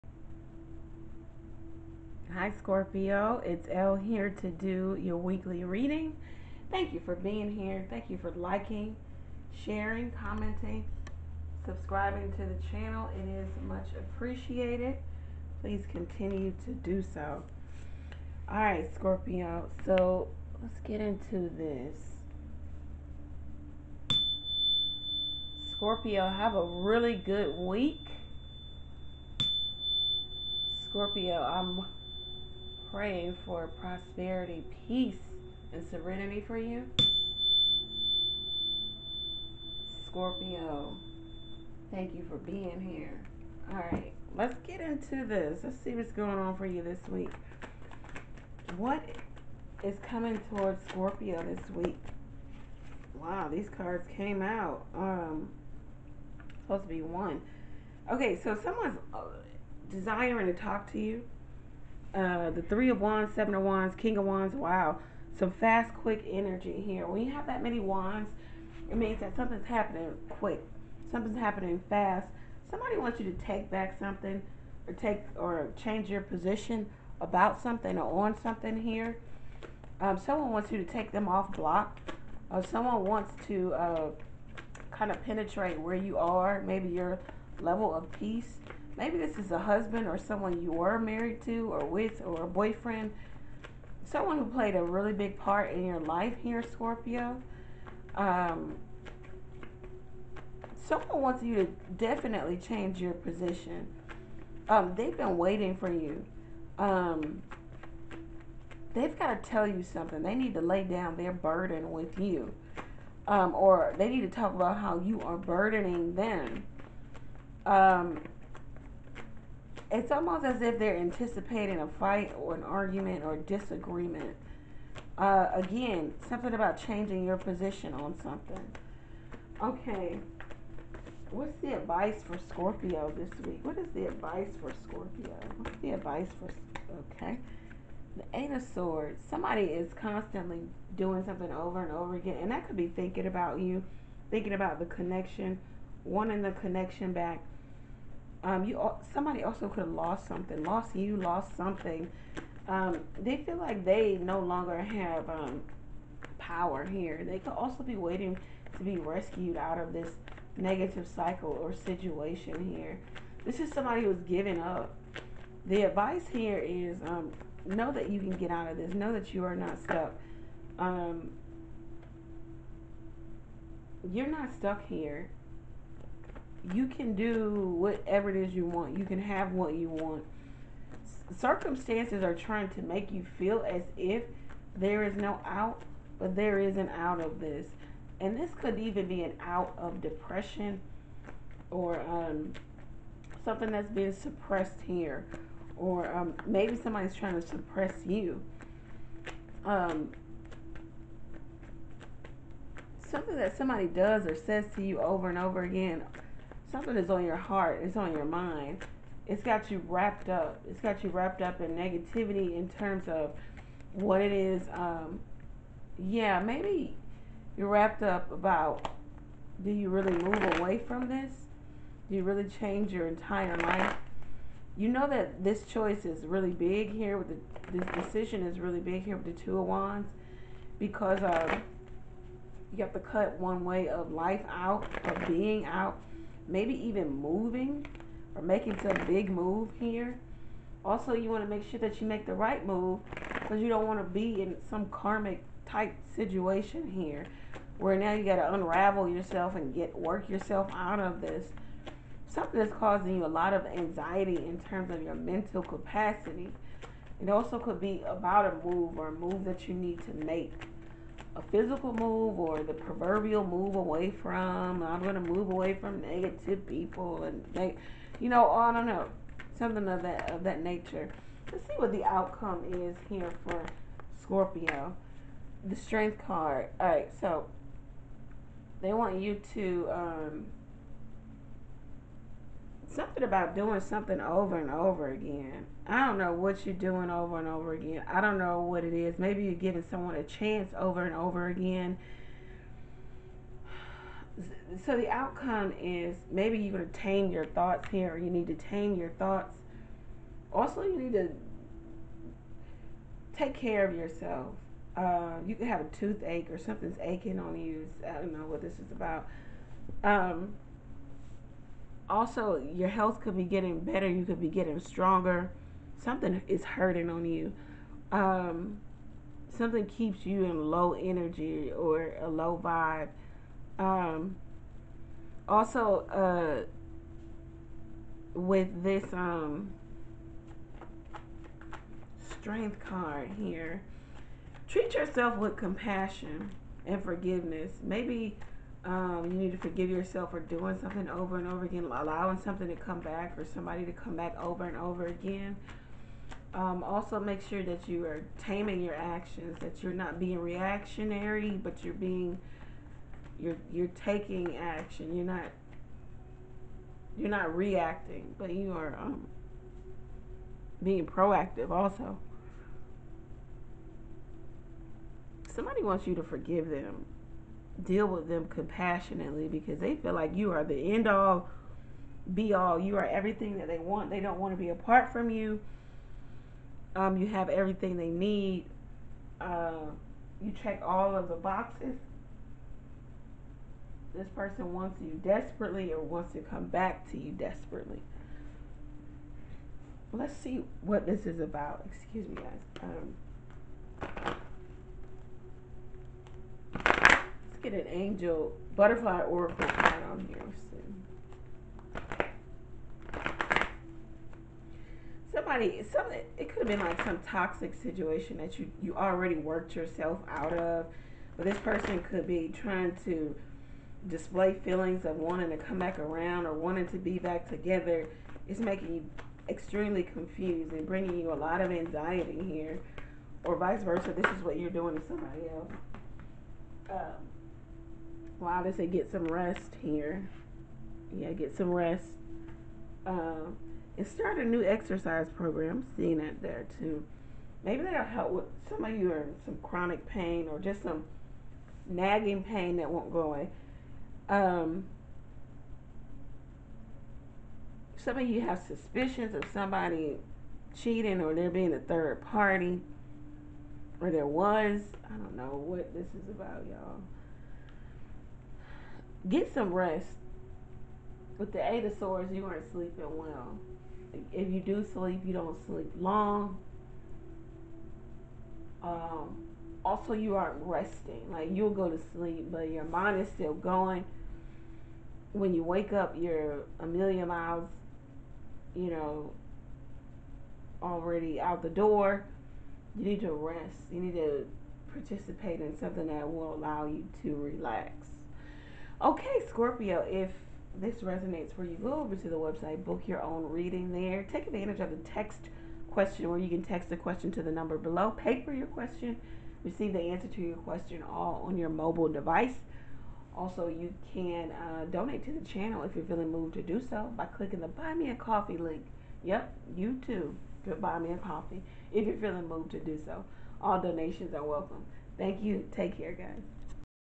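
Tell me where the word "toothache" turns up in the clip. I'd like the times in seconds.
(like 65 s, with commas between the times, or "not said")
305 s.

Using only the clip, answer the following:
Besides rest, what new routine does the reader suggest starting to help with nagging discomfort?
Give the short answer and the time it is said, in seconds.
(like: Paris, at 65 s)
exercise program, at 434 s.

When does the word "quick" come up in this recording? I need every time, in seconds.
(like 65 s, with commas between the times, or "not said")
65 s, 70 s.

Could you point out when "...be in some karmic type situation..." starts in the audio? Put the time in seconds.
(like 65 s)
244 s.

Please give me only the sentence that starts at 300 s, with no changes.
Also, you need to take care of yourself.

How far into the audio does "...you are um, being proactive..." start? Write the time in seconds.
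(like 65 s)
358 s.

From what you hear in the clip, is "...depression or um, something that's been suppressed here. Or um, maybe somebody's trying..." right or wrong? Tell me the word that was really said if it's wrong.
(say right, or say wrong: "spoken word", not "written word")
right.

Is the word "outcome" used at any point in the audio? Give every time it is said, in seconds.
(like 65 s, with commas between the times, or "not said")
272 s, 295 s.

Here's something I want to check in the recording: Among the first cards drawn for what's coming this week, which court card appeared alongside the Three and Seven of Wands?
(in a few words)
King of Wands.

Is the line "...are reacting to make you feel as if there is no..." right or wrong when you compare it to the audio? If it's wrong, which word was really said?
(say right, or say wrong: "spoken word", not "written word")
wrong: "trying", not "reacting".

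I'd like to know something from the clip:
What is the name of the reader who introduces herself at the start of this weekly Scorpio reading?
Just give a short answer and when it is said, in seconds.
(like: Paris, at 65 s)
Elle, at 3 s.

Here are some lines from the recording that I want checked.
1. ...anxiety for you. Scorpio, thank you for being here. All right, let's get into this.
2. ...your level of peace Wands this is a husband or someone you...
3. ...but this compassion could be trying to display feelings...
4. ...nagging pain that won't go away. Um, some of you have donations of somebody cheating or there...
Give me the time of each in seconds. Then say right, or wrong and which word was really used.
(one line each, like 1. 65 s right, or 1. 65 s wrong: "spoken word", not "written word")
1. 35 s wrong: "serenity", not "anxiety"
2. 86 s wrong: "Maybe", not "Wands"
3. 411 s wrong: "person", not "compassion"
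4. 441 s wrong: "suspicions", not "donations".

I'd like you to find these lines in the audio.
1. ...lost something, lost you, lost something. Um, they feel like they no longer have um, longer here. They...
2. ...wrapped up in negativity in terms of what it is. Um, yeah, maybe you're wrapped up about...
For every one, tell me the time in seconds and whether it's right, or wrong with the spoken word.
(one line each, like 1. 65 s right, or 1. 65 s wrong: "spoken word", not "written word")
1. 149 s wrong: "power", not "longer"
2. 211 s right.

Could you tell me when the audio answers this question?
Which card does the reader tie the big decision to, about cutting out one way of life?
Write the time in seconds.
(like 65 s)
229 s.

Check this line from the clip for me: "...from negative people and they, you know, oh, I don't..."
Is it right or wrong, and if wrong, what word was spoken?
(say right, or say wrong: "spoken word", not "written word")
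right.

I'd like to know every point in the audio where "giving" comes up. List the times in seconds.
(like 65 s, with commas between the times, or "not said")
164 s, 289 s.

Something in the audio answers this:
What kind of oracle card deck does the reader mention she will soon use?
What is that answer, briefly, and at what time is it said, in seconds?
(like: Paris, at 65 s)
Angel butterfly oracle, at 397 s.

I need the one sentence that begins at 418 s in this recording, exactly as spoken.
It's making you extremely confused and bringing you a lot of anxiety here, or vice versa.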